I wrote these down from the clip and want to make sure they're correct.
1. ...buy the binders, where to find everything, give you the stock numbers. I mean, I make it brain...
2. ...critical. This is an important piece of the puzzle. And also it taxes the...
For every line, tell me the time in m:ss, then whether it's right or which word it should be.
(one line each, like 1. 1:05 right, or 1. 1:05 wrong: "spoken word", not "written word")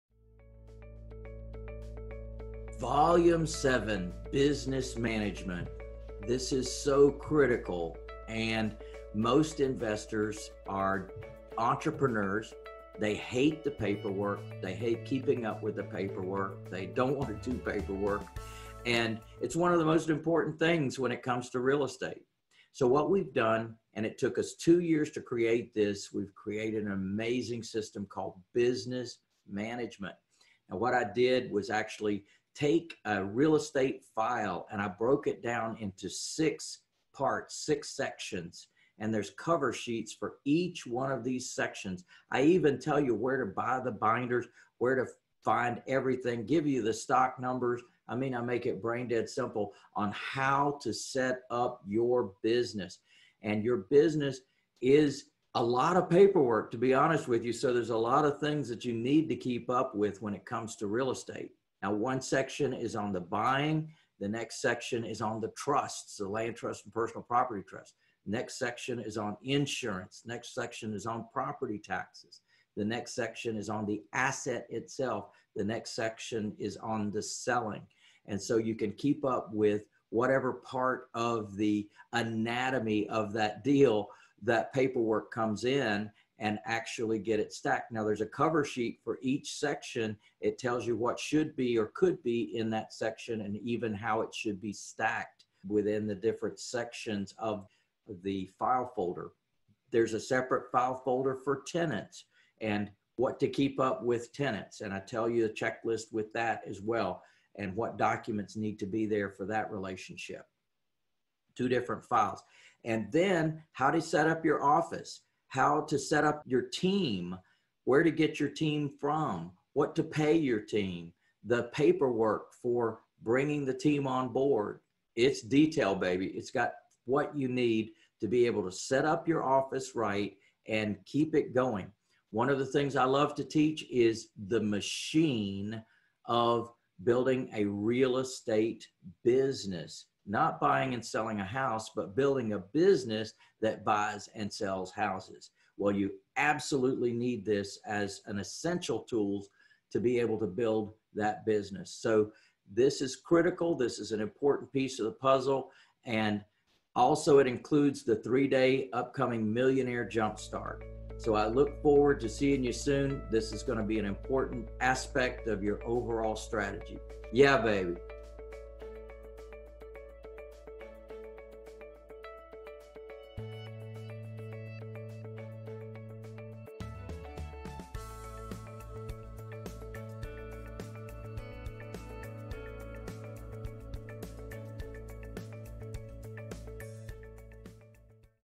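1. 0:43 right
2. 2:33 wrong: "includes", not "taxes".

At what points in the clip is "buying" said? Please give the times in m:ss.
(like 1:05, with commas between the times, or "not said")
1:03, 2:20.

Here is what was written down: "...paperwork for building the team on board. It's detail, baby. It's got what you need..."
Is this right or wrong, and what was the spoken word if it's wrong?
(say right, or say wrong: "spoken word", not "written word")
wrong: "bringing", not "building".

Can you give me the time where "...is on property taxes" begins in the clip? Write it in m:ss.
1:10.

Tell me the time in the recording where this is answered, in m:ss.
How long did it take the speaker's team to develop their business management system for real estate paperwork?
0:24.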